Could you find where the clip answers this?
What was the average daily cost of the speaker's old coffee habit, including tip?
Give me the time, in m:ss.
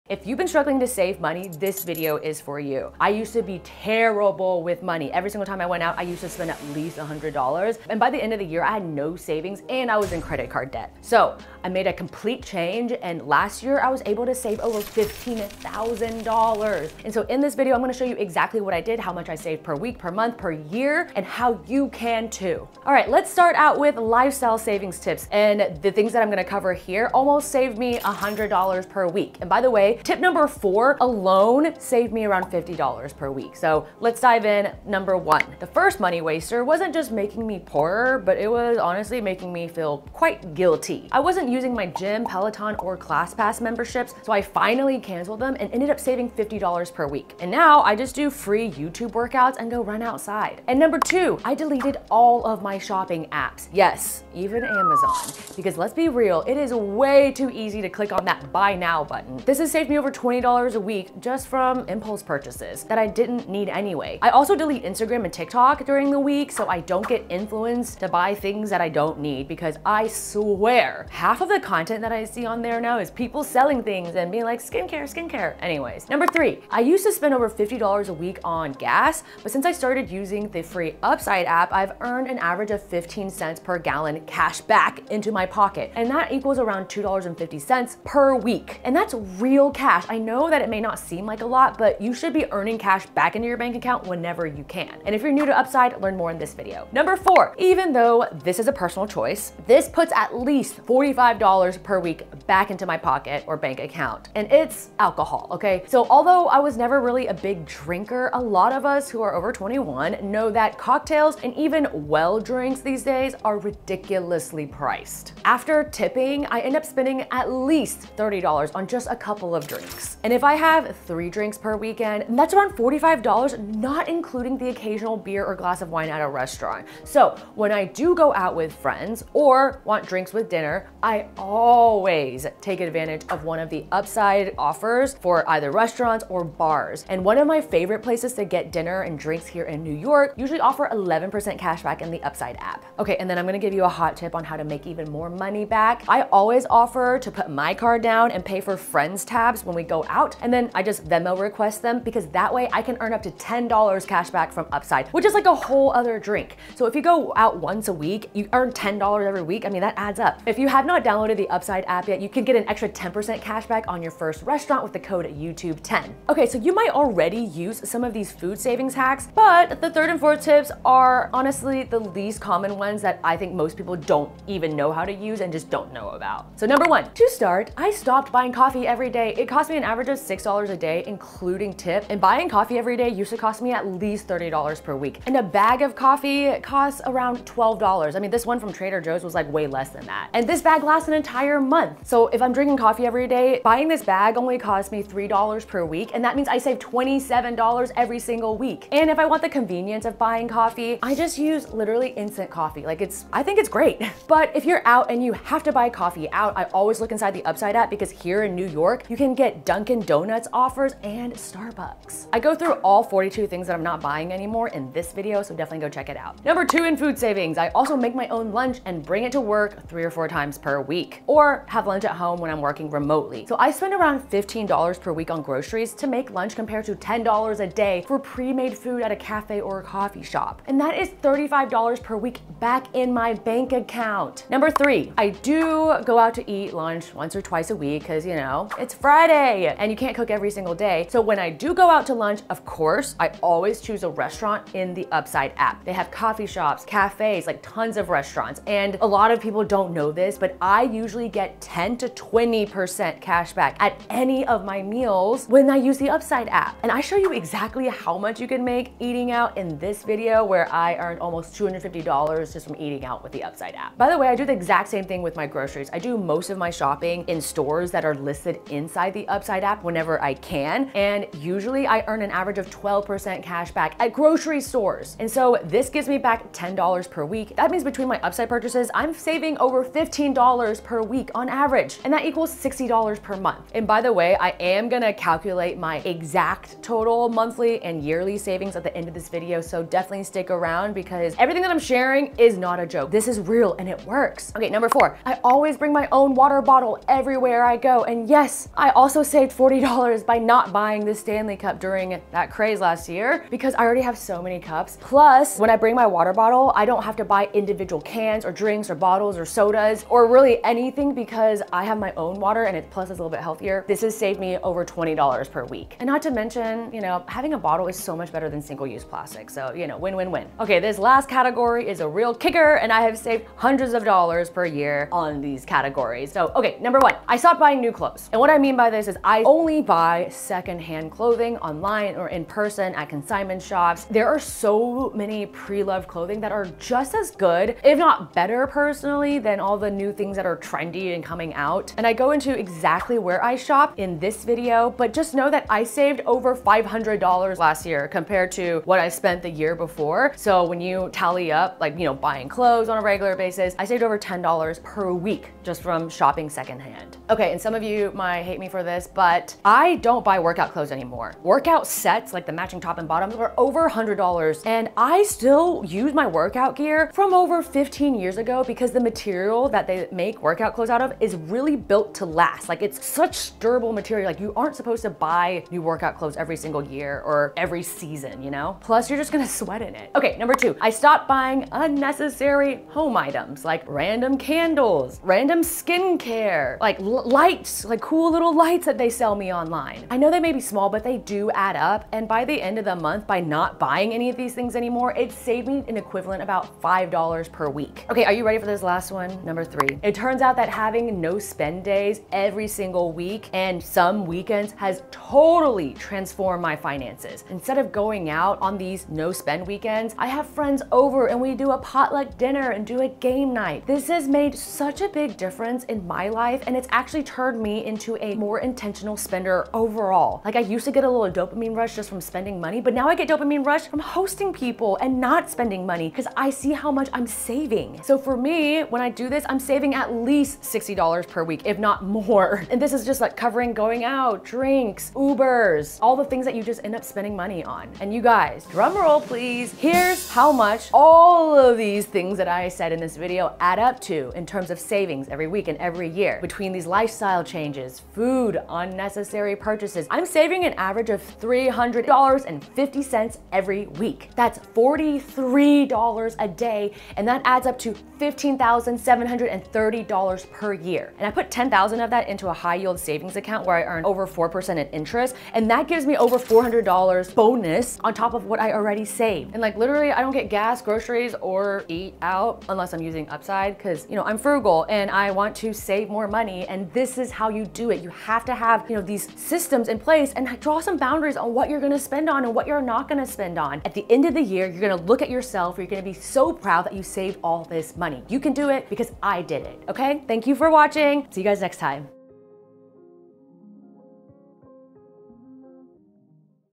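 3:00.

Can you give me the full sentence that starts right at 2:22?
Okay, and then I'm gonna give you a hot tip on how to make even more money back.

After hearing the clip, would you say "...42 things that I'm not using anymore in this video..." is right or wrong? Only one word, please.
wrong.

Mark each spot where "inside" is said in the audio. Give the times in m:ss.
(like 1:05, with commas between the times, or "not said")
3:27, 4:28.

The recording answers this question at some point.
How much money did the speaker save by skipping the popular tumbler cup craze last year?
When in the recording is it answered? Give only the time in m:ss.
4:59.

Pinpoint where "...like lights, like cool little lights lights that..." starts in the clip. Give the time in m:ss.
6:26.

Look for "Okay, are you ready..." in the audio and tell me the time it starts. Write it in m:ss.
6:38.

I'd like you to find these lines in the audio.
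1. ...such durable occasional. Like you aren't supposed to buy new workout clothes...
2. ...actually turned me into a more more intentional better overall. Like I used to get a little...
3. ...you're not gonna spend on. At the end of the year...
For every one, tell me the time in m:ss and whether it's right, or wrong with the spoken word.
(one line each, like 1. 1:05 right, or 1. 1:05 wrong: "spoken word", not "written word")
1. 6:13 wrong: "material", not "occasional"
2. 6:56 wrong: "spender", not "better"
3. 8:02 right.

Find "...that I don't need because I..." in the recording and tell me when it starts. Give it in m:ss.
1:08.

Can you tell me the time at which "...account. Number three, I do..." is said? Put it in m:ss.
3:53.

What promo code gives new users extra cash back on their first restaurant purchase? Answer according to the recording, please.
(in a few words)
YouTube10.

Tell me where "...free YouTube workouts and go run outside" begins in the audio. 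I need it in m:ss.
0:48.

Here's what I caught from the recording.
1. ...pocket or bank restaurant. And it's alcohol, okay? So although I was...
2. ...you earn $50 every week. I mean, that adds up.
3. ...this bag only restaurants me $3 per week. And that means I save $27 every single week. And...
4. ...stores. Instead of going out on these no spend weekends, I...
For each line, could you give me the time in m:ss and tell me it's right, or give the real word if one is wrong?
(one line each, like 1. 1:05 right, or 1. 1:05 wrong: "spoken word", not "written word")
1. 1:42 wrong: "account", not "restaurant"
2. 2:38 wrong: "10", not "50"
3. 3:13 wrong: "costs", not "restaurants"
4. 6:46 wrong: "finances", not "stores".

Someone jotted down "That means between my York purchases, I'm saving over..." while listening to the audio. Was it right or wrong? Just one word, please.
wrong.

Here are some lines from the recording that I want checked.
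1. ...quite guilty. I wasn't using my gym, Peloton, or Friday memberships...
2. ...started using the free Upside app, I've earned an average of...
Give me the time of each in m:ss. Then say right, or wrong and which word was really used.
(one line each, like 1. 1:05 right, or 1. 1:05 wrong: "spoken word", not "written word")
1. 0:40 wrong: "ClassPass", not "Friday"
2. 1:19 right.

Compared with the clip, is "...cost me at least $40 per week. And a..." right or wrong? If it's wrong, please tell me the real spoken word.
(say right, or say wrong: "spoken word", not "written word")
wrong: "30", not "40".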